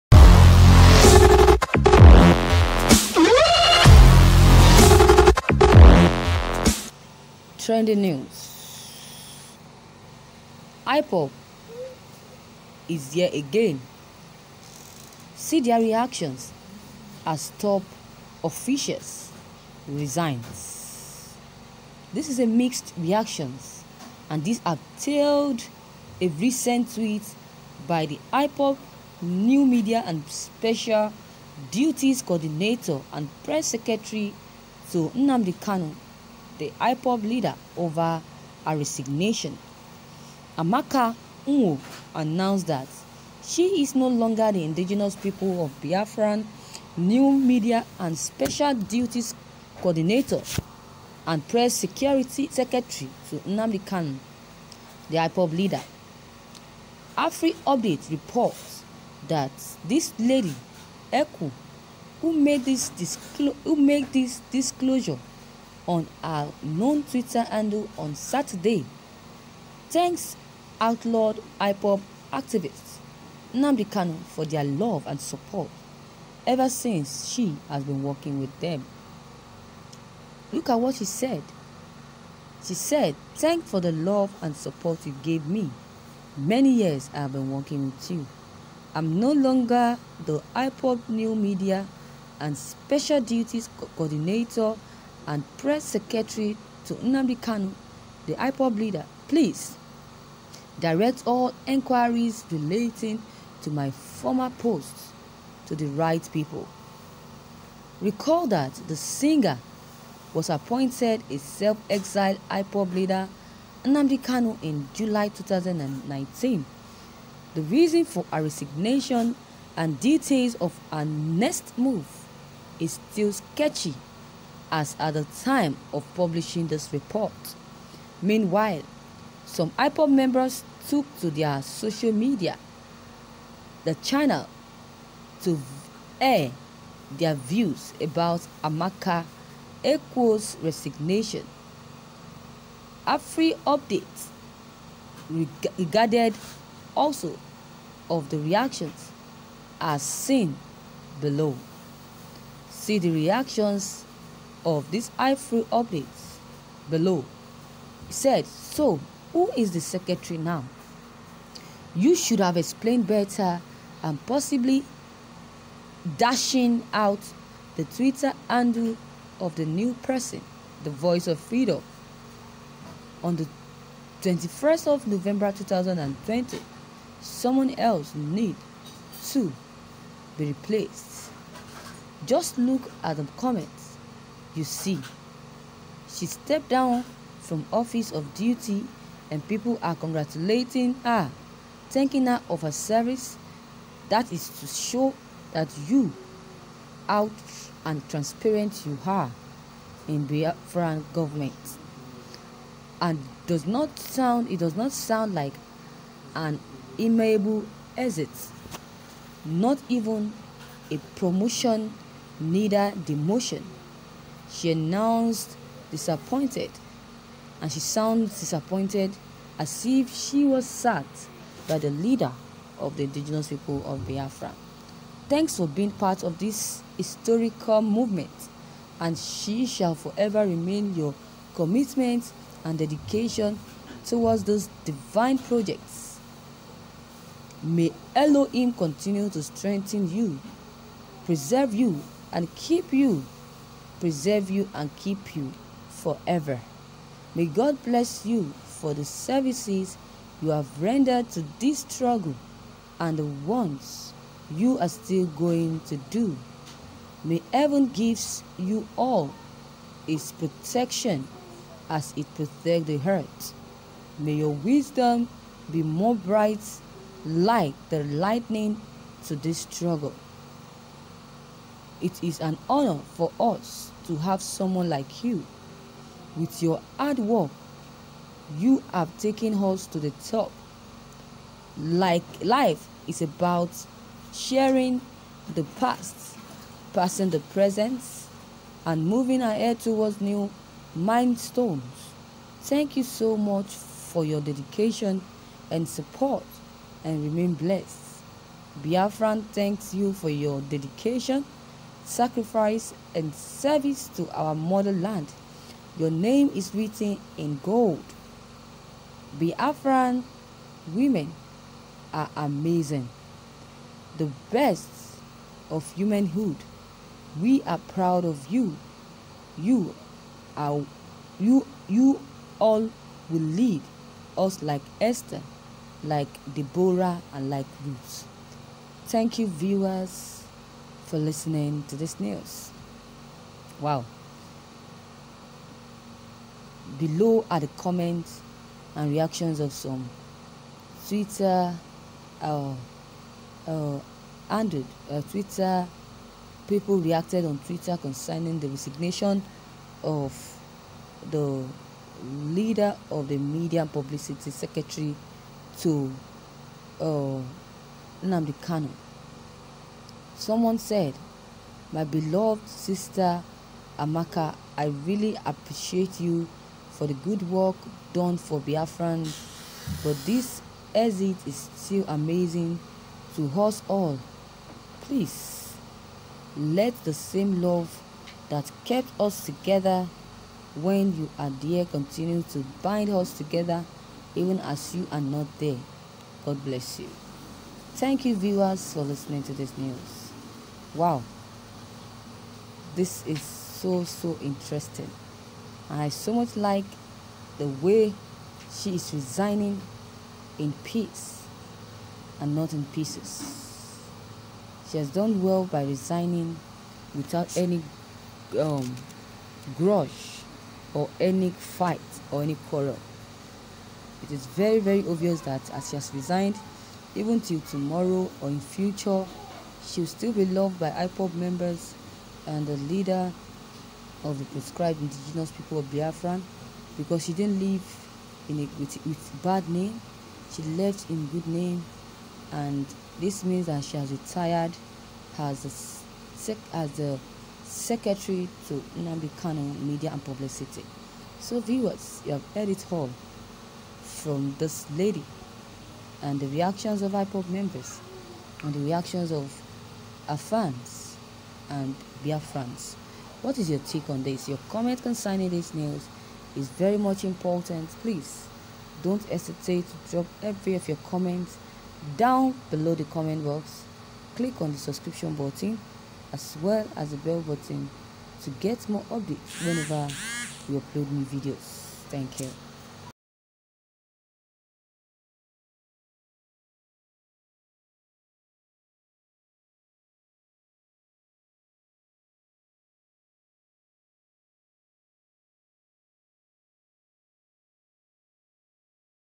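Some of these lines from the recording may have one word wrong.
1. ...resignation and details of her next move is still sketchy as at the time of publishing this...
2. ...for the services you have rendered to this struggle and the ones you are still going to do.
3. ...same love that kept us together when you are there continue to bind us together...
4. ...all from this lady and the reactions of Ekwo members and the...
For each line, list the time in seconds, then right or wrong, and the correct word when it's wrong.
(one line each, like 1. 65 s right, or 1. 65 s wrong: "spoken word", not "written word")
1. 118 s right
2. 248 s right
3. 377 s right
4. 442 s wrong: "IPOB", not "Ekwo".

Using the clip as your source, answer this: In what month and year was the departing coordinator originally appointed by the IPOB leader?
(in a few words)
July 2019.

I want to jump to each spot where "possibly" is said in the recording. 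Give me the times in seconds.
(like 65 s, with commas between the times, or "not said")
164 s.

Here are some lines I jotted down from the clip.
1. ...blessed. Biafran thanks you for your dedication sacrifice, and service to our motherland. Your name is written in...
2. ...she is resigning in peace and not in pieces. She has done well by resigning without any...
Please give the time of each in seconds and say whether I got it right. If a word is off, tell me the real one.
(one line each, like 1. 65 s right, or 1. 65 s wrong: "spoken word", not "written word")
1. 297 s right
2. 398 s right.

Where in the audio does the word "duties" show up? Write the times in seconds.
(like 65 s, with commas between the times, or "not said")
31 s, 48 s, 93 s.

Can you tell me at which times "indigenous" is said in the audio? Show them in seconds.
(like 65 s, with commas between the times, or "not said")
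44 s, 223 s, 425 s.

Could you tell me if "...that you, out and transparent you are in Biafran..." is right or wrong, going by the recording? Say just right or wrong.
right.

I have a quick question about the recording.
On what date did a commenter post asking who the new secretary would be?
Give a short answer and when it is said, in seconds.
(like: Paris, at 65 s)
21 November 2020, at 174 s.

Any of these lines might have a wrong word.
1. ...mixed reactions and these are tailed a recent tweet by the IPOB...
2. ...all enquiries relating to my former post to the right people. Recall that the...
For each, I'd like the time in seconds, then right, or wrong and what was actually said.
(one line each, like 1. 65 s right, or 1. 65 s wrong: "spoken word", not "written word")
1. 22 s right
2. 101 s right.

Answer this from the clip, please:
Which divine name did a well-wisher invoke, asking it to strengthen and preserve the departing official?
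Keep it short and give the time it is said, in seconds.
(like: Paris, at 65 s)
Elohim, at 238 s.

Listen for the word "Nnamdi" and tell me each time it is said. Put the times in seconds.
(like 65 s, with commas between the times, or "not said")
35 s, 53 s, 73 s, 96 s, 113 s, 358 s, 438 s.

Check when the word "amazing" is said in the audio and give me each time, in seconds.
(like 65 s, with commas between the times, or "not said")
312 s, 372 s.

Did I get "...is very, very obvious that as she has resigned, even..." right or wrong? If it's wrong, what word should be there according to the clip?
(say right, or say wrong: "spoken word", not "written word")
right.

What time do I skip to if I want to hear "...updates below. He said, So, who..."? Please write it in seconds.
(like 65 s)
155 s.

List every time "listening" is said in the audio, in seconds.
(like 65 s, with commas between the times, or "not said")
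331 s, 389 s.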